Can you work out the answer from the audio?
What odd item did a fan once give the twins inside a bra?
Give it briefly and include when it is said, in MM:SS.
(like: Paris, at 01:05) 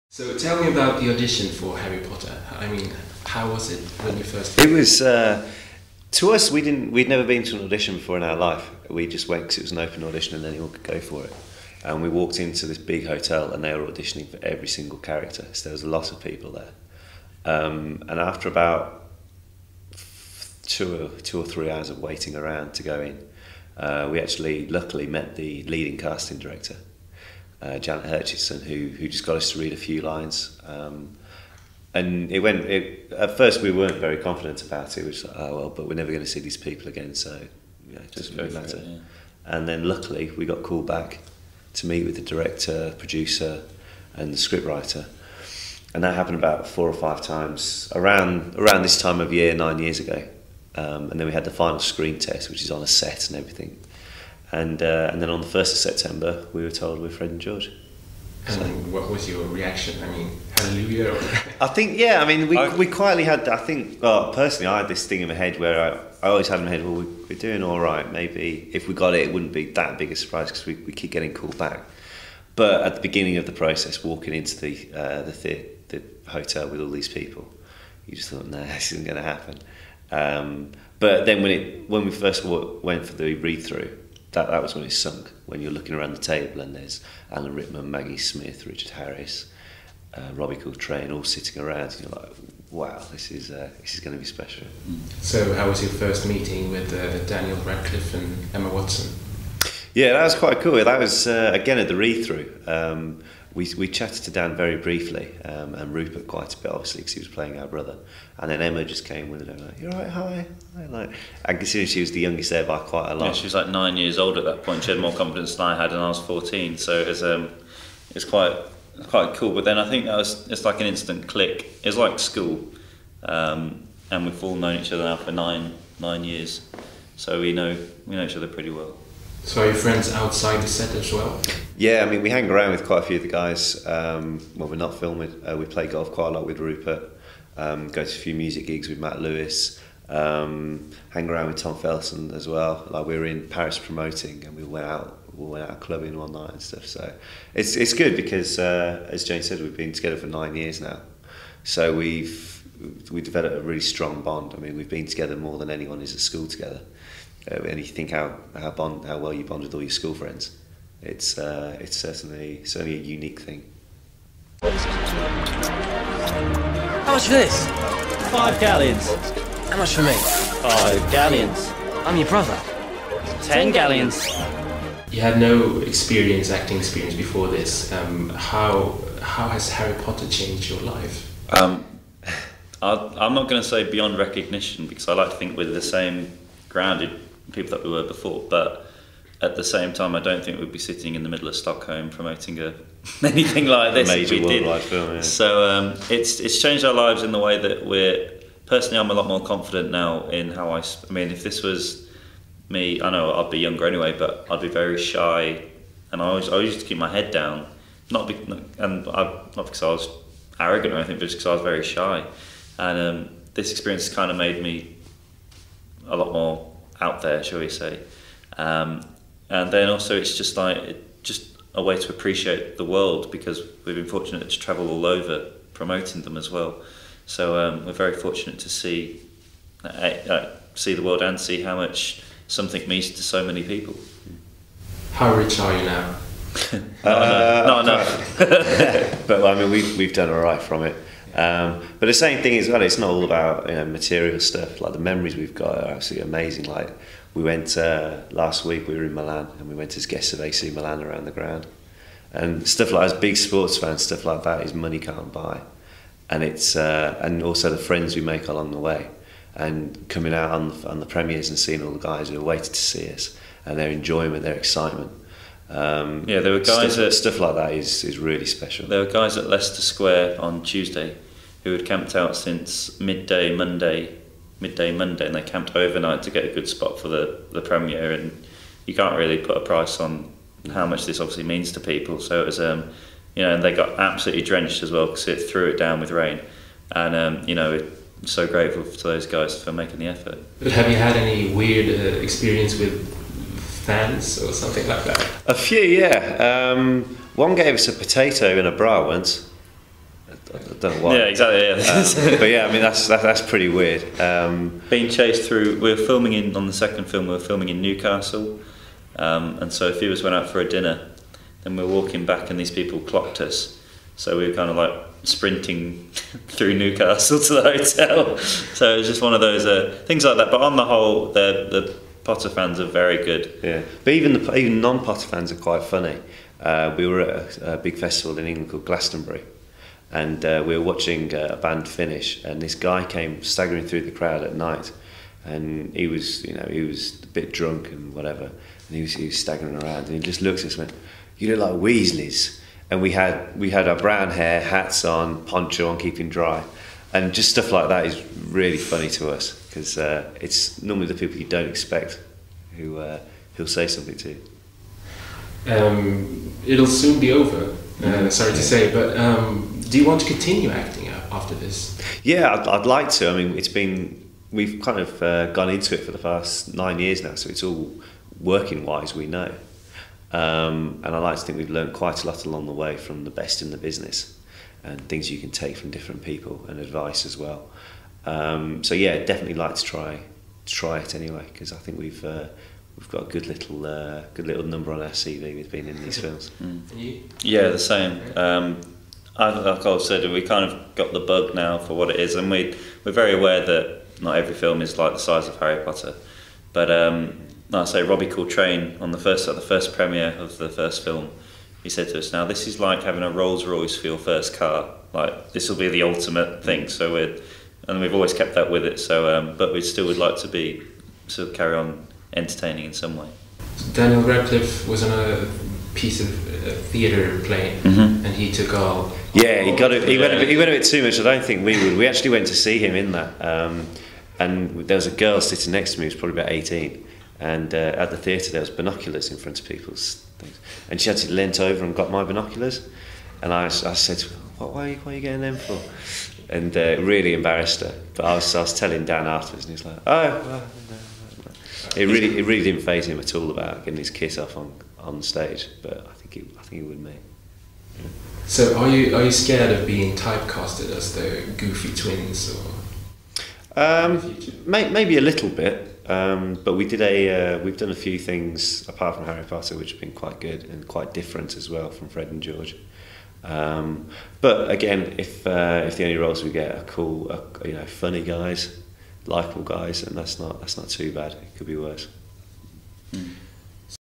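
A potato, at 04:57.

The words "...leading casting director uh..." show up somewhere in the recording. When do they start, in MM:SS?
00:25.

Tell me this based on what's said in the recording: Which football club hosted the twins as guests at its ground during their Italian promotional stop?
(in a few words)
AC Milan.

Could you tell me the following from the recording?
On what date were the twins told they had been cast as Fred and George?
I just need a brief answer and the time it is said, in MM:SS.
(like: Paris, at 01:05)
1st of September, at 00:55.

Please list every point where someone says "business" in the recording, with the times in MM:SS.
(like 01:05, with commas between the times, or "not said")
06:13.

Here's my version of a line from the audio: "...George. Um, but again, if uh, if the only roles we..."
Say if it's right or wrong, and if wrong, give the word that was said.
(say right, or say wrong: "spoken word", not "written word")
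right.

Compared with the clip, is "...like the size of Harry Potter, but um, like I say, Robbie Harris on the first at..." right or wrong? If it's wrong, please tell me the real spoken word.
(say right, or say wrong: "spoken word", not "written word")
wrong: "Coltrane", not "Harris".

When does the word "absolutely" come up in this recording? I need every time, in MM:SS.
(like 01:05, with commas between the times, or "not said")
04:05, 04:43.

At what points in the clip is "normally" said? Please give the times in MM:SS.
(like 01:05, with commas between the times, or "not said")
05:50.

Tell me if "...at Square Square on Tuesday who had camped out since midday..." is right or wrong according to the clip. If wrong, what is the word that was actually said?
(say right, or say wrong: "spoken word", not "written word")
wrong: "Leicester", not "Square".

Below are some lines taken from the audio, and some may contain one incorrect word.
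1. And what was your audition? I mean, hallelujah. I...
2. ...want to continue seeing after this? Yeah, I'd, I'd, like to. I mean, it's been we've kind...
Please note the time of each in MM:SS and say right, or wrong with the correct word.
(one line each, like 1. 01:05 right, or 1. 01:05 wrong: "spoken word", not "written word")
1. 00:58 wrong: "reaction", not "audition"
2. 06:00 wrong: "acting", not "seeing".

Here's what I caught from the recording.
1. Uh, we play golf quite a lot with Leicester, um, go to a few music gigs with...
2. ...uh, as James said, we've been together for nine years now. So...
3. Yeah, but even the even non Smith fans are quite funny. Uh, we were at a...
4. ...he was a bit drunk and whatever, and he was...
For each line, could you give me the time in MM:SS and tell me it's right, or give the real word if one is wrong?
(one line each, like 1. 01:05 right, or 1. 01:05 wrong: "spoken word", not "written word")
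1. 02:15 wrong: "Rupert", not "Leicester"
2. 02:28 right
3. 05:23 wrong: "Potter", not "Smith"
4. 05:36 right.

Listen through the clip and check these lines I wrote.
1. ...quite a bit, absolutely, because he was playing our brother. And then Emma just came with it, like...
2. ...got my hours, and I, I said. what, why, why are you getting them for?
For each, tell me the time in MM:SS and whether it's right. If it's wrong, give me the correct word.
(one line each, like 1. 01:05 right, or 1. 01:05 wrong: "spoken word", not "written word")
1. 01:46 wrong: "obviously", not "absolutely"
2. 07:11 wrong: "binoculars", not "hours".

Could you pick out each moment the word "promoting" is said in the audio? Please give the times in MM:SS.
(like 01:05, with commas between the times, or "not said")
02:23, 03:12, 03:45.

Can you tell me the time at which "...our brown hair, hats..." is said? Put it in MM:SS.
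05:43.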